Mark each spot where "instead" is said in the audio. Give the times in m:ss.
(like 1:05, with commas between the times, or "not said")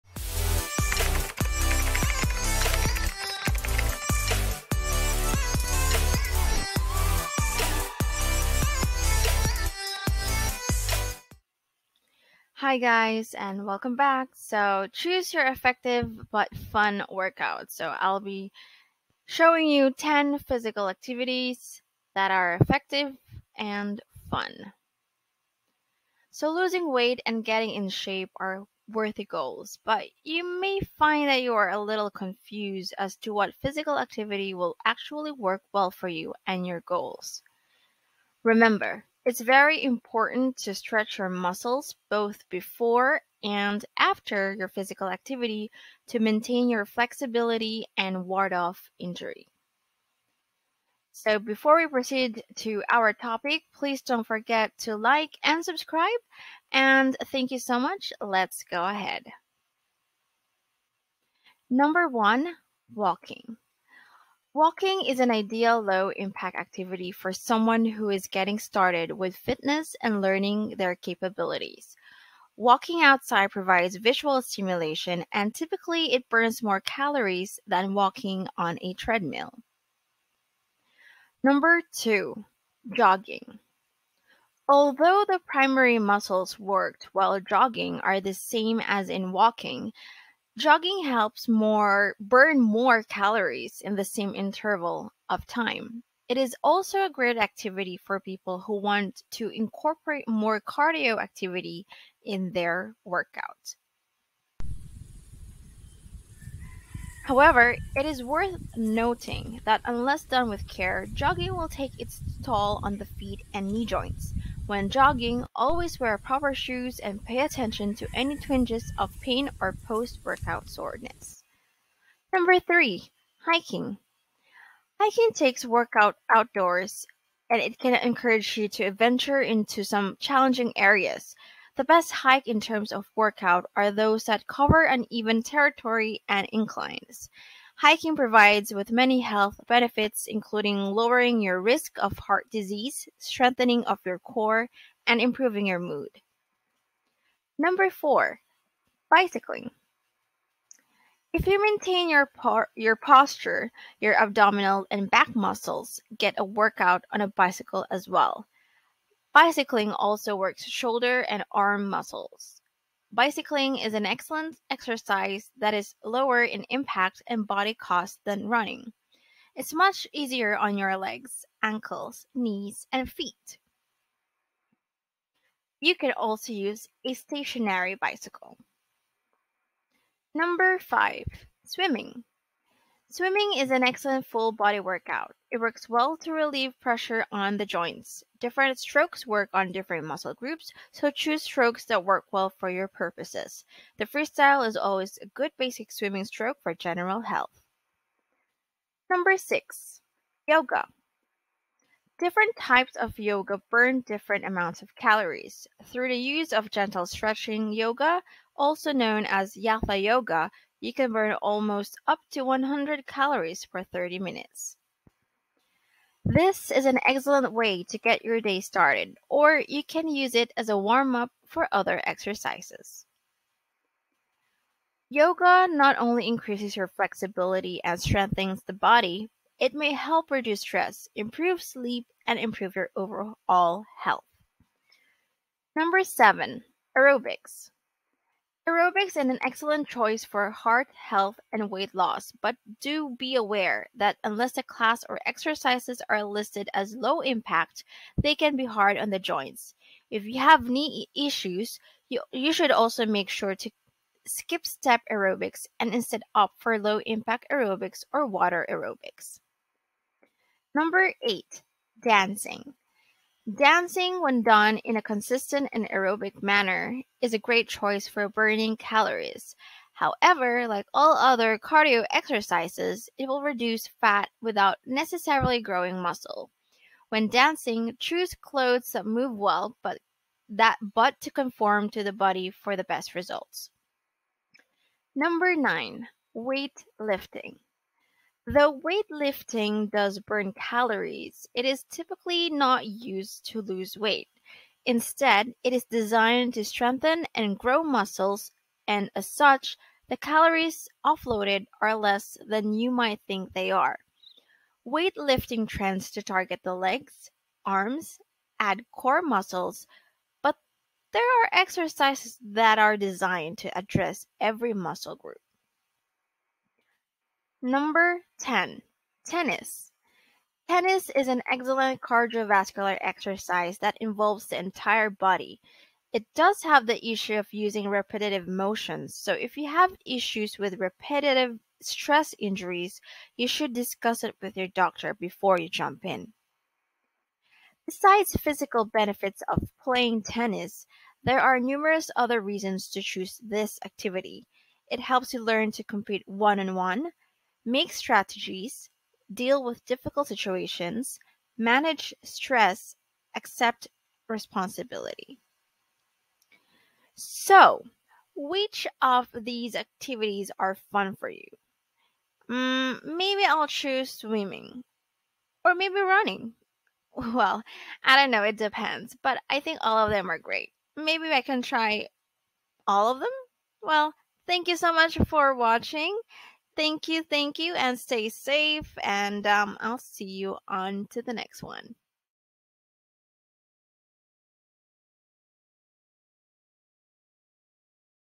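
4:15, 4:54.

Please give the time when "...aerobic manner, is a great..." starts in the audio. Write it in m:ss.
4:25.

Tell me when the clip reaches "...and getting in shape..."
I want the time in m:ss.
0:27.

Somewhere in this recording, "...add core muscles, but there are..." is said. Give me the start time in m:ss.
5:08.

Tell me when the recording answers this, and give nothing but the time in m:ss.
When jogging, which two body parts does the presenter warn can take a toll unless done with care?
1:53.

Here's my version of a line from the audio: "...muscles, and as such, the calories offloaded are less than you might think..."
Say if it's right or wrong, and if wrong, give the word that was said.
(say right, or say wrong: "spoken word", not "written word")
right.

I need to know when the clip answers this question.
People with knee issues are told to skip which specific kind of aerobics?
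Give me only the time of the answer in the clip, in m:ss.
4:14.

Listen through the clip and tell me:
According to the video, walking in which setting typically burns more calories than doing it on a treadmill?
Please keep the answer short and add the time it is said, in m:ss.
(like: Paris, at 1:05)
Outside, at 1:12.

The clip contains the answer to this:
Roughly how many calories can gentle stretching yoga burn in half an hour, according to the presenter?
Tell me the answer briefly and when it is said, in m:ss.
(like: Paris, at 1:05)
100, at 3:32.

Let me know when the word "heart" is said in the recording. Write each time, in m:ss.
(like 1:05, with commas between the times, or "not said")
2:22, 4:00.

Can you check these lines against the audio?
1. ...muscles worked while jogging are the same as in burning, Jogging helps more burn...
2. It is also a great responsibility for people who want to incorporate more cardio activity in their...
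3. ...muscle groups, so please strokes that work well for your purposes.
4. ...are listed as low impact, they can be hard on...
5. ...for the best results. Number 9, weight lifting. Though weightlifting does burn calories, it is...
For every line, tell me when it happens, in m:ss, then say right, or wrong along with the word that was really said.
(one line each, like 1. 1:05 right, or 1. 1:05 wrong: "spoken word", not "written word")
1. 1:25 wrong: "walking", not "burning"
2. 1:36 wrong: "activity", not "responsibility"
3. 3:10 wrong: "choose", not "please"
4. 4:06 right
5. 4:42 right.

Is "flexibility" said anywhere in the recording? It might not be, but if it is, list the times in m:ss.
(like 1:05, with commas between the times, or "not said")
0:46, 3:46.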